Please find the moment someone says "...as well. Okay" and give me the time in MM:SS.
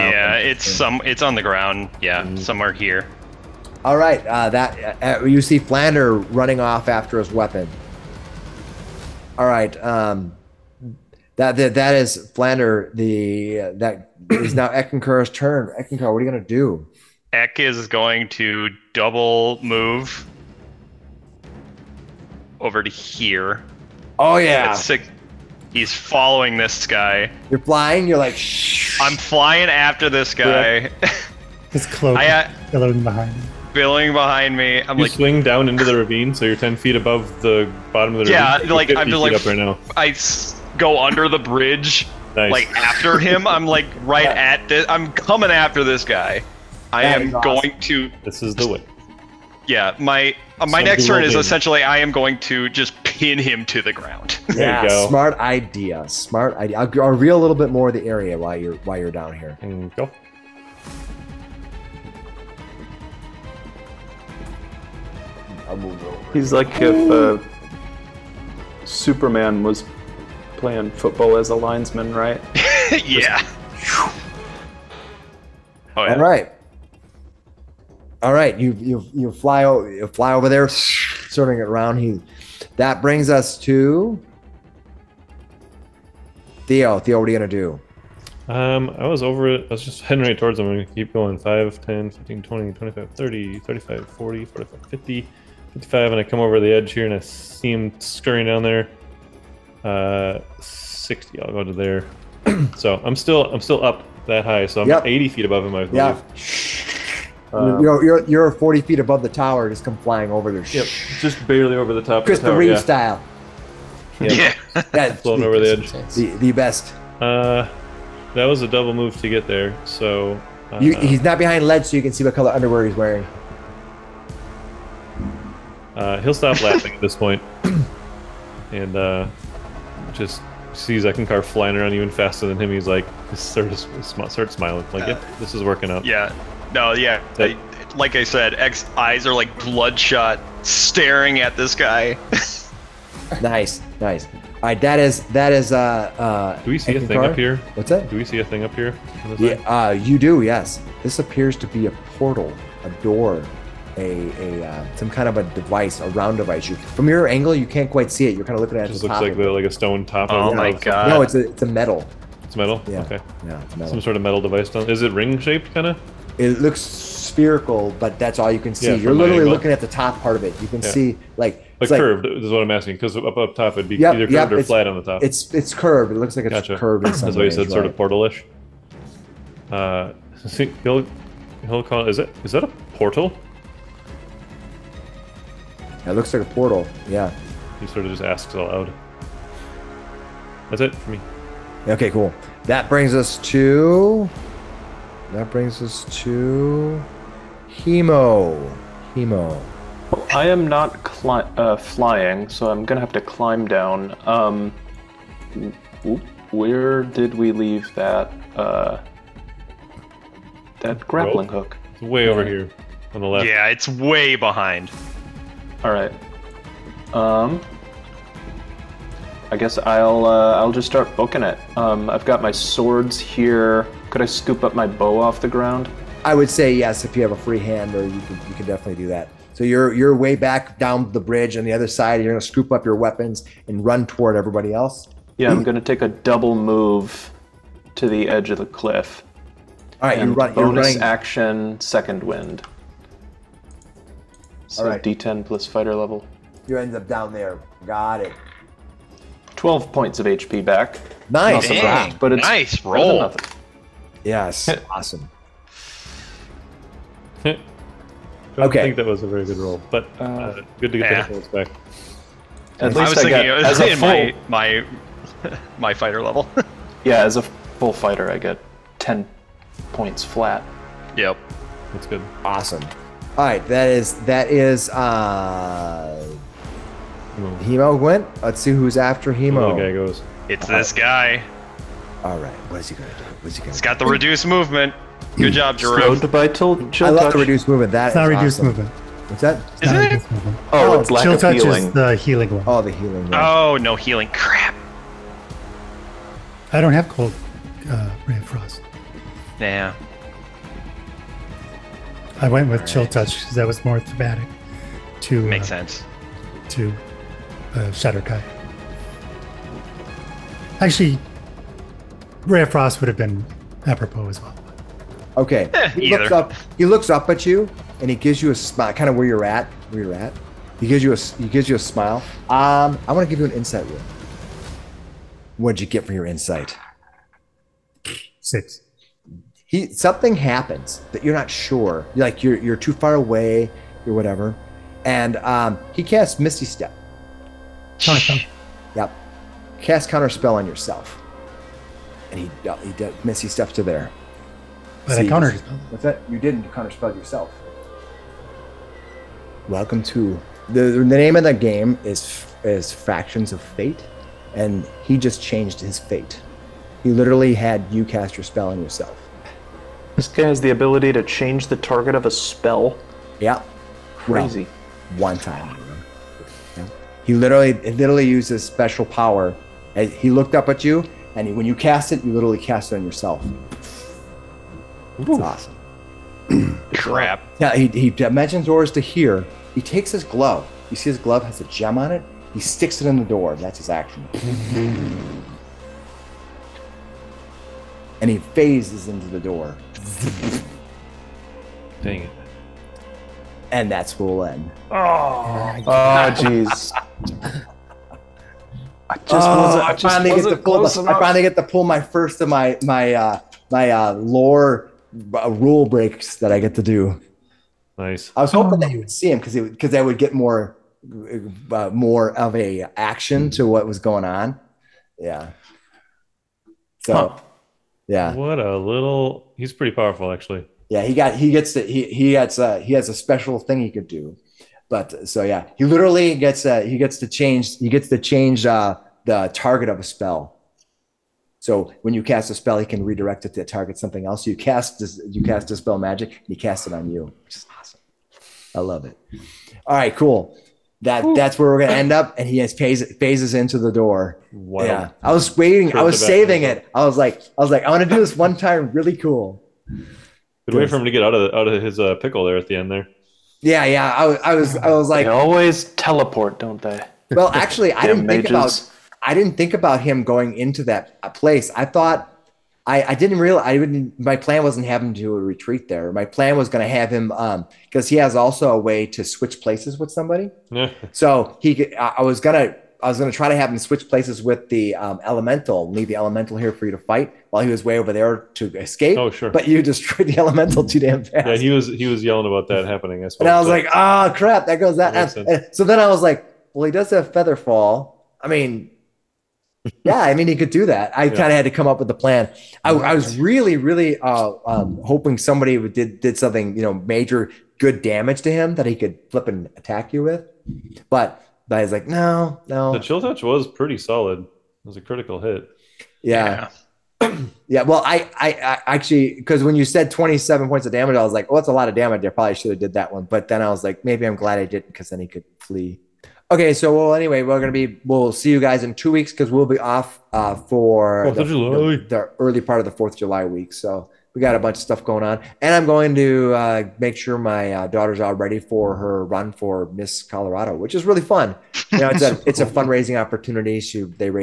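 05:14.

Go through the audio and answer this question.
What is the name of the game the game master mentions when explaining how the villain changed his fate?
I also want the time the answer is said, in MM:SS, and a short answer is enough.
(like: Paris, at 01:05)
Factions of Fate, at 05:52.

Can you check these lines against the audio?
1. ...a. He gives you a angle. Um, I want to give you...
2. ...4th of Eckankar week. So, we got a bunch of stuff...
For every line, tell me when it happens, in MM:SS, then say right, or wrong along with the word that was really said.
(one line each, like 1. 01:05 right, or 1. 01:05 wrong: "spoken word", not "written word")
1. 05:21 wrong: "smile", not "angle"
2. 08:42 wrong: "July", not "Eckankar".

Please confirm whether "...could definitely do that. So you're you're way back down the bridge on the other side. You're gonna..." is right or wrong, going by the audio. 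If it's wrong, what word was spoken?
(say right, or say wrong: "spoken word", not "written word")
right.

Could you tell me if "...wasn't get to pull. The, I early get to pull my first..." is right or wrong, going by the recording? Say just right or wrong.
wrong.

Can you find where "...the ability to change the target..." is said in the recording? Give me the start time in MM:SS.
06:00.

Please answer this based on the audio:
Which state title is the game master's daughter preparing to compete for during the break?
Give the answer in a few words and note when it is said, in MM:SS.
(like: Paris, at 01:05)
Miss Colorado, at 08:49.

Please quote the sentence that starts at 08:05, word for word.
that so then I was like, well, he does have feather fall.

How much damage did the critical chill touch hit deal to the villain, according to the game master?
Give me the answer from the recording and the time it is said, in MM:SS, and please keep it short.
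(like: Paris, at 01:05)
27, at 08:30.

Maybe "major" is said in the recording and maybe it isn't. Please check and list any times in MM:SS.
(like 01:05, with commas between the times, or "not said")
08:16.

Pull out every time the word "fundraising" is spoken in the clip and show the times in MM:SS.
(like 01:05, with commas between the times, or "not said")
08:52.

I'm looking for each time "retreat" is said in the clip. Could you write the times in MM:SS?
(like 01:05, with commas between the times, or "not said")
07:45.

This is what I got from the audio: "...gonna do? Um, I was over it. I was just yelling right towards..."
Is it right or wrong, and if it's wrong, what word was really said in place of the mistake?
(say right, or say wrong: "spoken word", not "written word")
wrong: "heading", not "yelling".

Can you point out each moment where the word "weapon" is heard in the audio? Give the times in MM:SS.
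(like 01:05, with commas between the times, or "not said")
00:07, 03:52.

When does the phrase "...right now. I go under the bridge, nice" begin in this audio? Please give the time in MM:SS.
00:39.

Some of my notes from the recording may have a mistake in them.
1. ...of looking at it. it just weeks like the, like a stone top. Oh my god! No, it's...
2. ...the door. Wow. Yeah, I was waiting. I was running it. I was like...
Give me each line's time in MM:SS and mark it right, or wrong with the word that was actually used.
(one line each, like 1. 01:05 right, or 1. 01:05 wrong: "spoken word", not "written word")
1. 02:38 wrong: "looks", not "weeks"
2. 07:23 wrong: "saving", not "running".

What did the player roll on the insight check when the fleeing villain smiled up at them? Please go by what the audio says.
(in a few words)
6.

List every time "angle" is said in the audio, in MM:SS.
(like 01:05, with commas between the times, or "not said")
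02:37, 02:49.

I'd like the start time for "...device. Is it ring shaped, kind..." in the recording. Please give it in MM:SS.
02:44.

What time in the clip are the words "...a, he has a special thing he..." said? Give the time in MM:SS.
07:02.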